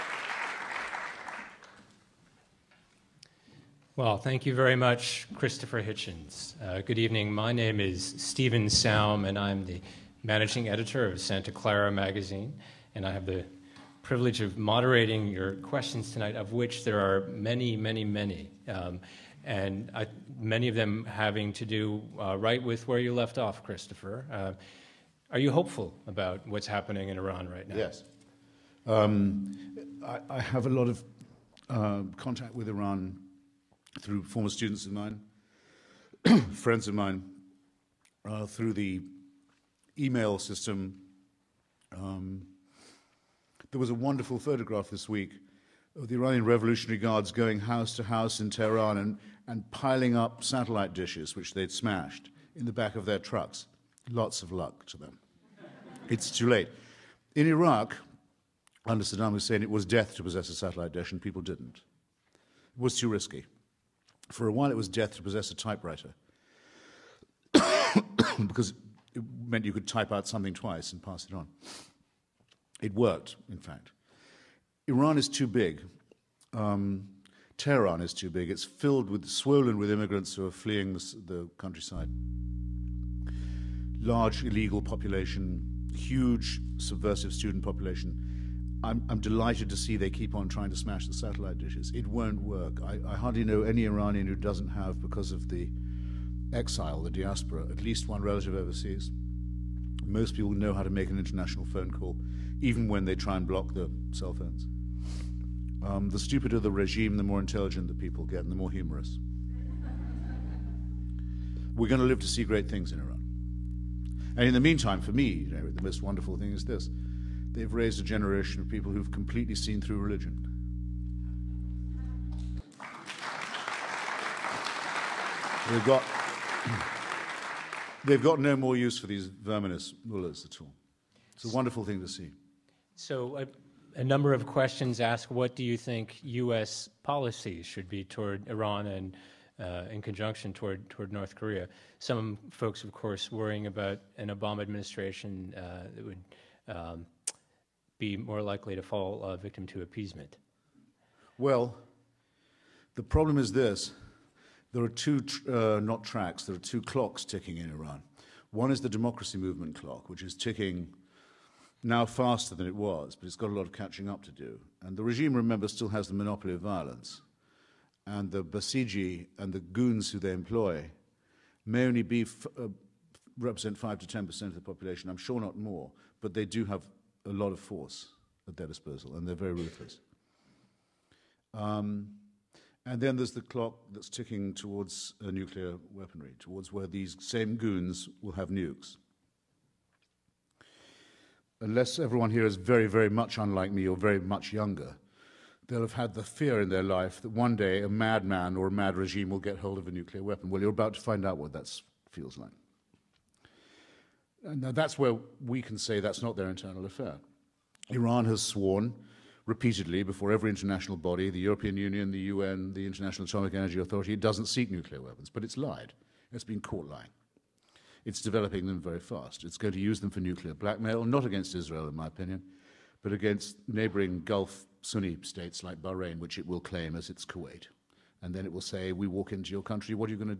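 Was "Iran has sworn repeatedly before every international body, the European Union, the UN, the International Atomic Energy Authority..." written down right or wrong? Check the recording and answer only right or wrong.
right.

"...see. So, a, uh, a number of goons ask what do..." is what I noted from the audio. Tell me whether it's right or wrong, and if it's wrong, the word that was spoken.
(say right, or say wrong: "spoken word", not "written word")
wrong: "questions", not "goons".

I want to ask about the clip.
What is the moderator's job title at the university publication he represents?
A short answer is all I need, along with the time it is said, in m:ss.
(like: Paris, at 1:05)
Managing editor, at 0:10.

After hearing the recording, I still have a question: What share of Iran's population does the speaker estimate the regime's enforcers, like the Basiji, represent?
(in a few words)
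5 to 10%.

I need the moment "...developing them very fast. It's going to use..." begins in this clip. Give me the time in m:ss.
3:38.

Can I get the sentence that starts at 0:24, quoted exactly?
Uh, are you hopeful about what's happening in Iran right now?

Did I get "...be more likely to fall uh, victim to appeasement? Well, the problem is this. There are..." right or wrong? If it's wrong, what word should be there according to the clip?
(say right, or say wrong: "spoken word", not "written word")
right.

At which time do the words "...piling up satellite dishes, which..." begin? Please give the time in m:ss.
0:49.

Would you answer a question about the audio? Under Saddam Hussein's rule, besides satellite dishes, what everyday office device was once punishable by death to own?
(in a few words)
Typewriter.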